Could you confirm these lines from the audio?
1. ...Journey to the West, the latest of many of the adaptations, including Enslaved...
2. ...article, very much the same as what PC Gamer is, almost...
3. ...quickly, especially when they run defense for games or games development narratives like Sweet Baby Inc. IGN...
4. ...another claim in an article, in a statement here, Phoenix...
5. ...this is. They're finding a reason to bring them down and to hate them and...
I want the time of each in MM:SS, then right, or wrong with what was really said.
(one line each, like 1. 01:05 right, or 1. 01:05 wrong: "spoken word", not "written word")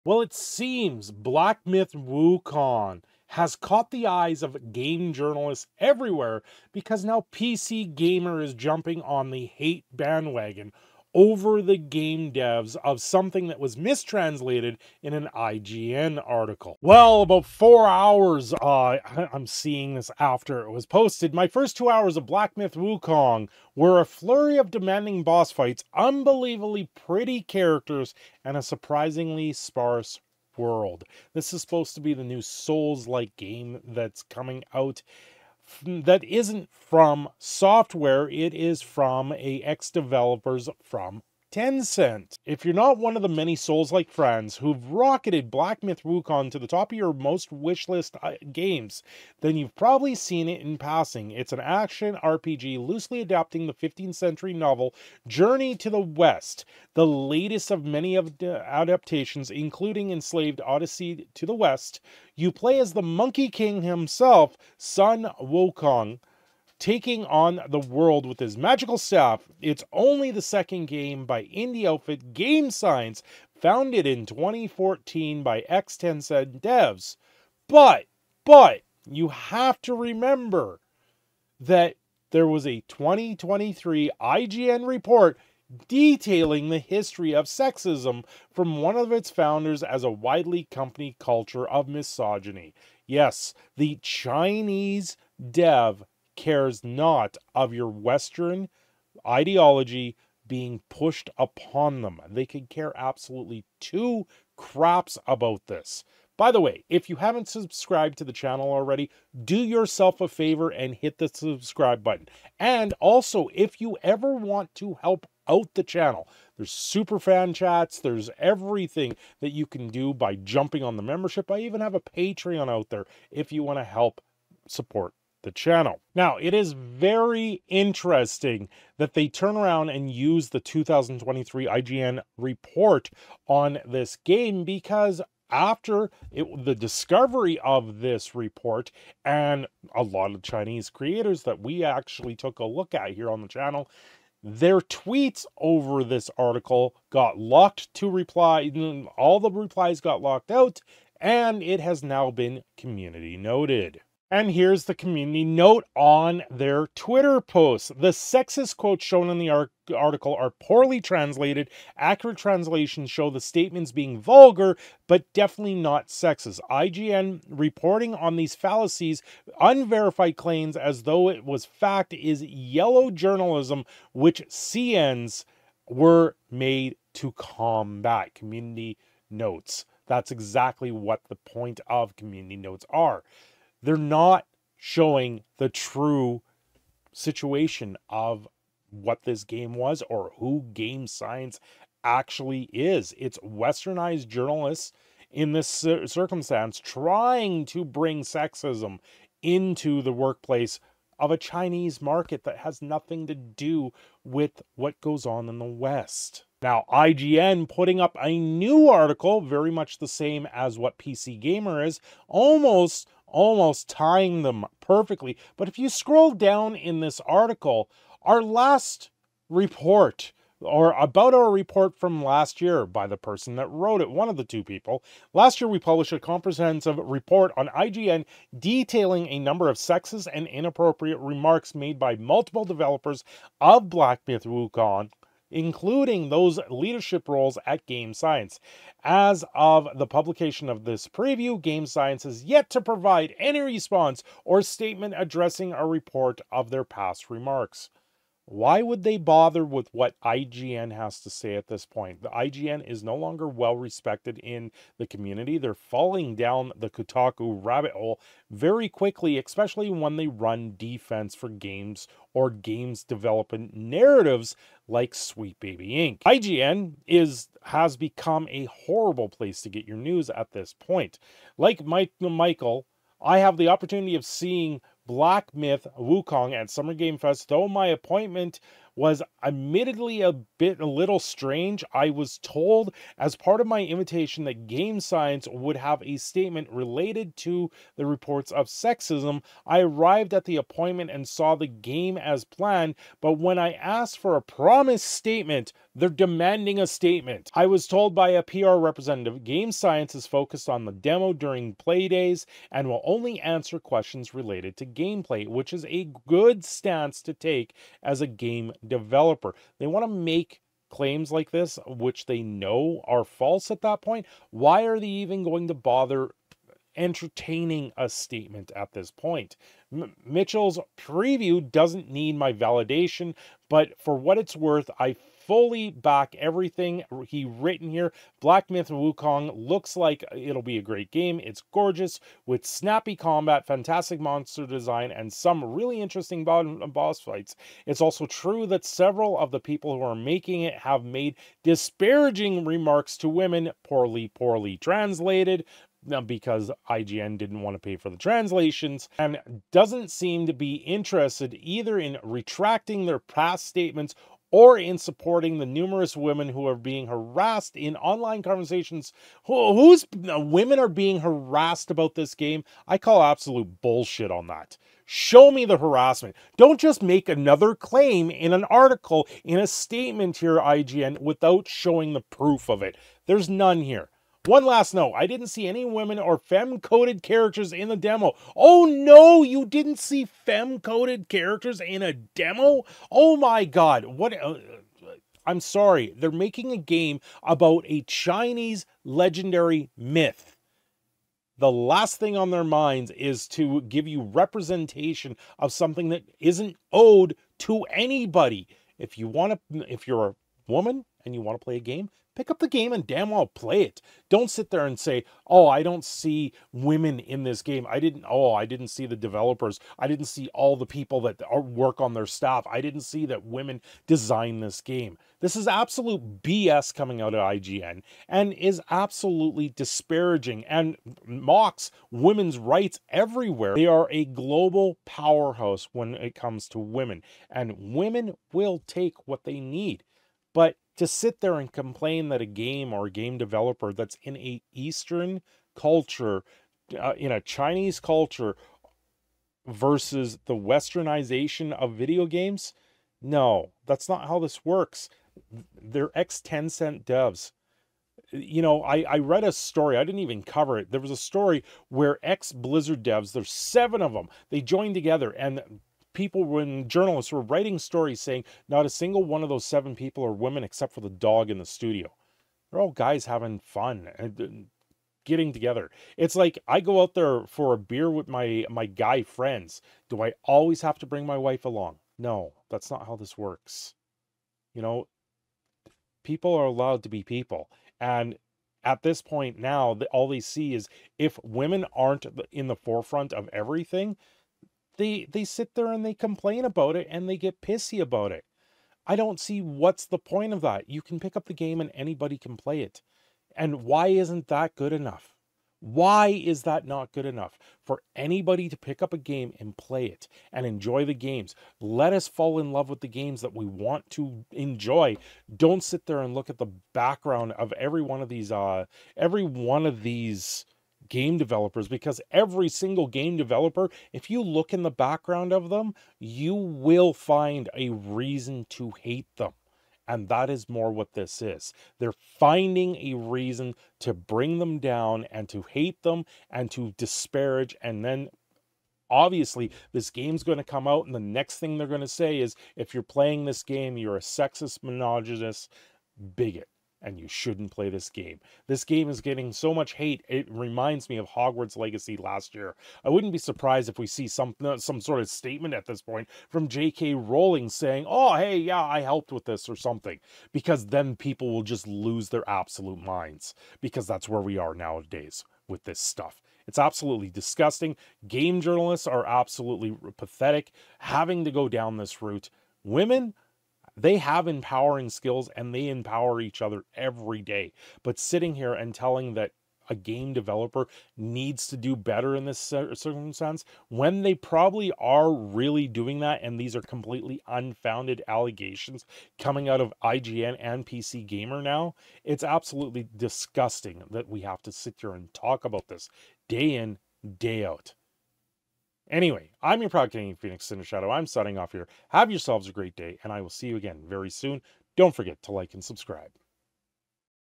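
1. 00:55 right
2. 03:28 right
3. 04:18 right
4. 06:07 wrong: "IGN", not "Phoenix"
5. 08:41 right.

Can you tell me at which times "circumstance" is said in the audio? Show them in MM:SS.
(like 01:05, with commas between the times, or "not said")
03:15, 09:32.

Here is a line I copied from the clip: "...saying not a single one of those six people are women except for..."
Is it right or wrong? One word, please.
wrong.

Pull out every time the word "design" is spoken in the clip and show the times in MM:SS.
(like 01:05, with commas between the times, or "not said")
05:34, 06:54.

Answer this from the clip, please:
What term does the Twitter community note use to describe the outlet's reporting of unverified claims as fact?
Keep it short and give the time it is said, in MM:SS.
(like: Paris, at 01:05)
yellow journalism, at 02:52.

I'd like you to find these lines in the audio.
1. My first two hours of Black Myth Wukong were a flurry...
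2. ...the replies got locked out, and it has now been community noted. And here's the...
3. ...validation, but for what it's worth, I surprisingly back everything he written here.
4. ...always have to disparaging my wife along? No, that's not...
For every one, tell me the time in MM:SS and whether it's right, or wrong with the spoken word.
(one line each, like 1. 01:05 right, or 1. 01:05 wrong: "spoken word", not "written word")
1. 00:21 right
2. 02:29 right
3. 05:22 wrong: "fully", not "surprisingly"
4. 07:50 wrong: "bring", not "disparaging".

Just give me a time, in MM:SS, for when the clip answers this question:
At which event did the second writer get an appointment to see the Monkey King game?
04:36.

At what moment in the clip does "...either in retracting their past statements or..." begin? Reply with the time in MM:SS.
05:51.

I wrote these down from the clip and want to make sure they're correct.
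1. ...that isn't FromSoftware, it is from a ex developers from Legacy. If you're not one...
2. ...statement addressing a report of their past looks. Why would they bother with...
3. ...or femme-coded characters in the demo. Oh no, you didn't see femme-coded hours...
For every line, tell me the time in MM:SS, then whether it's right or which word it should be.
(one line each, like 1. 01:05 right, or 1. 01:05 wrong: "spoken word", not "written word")
1. 00:35 wrong: "Tencent", not "Legacy"
2. 04:04 wrong: "remarks", not "looks"
3. 06:16 wrong: "characters", not "hours".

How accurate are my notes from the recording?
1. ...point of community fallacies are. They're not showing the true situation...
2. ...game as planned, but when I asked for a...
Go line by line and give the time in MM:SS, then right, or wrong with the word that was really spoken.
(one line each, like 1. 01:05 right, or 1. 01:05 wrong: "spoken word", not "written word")
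1. 03:01 wrong: "notes", not "fallacies"
2. 04:51 right.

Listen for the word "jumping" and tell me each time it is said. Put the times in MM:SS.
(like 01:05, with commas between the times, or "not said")
00:08, 02:00.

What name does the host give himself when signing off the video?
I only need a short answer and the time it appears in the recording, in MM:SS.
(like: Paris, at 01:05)
Phoenix Cindershadow, at 09:50.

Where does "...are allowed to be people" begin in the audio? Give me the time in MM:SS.
07:56.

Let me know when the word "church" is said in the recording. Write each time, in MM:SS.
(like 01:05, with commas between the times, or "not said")
not said.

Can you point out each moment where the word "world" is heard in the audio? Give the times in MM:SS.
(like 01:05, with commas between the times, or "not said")
00:30, 01:07.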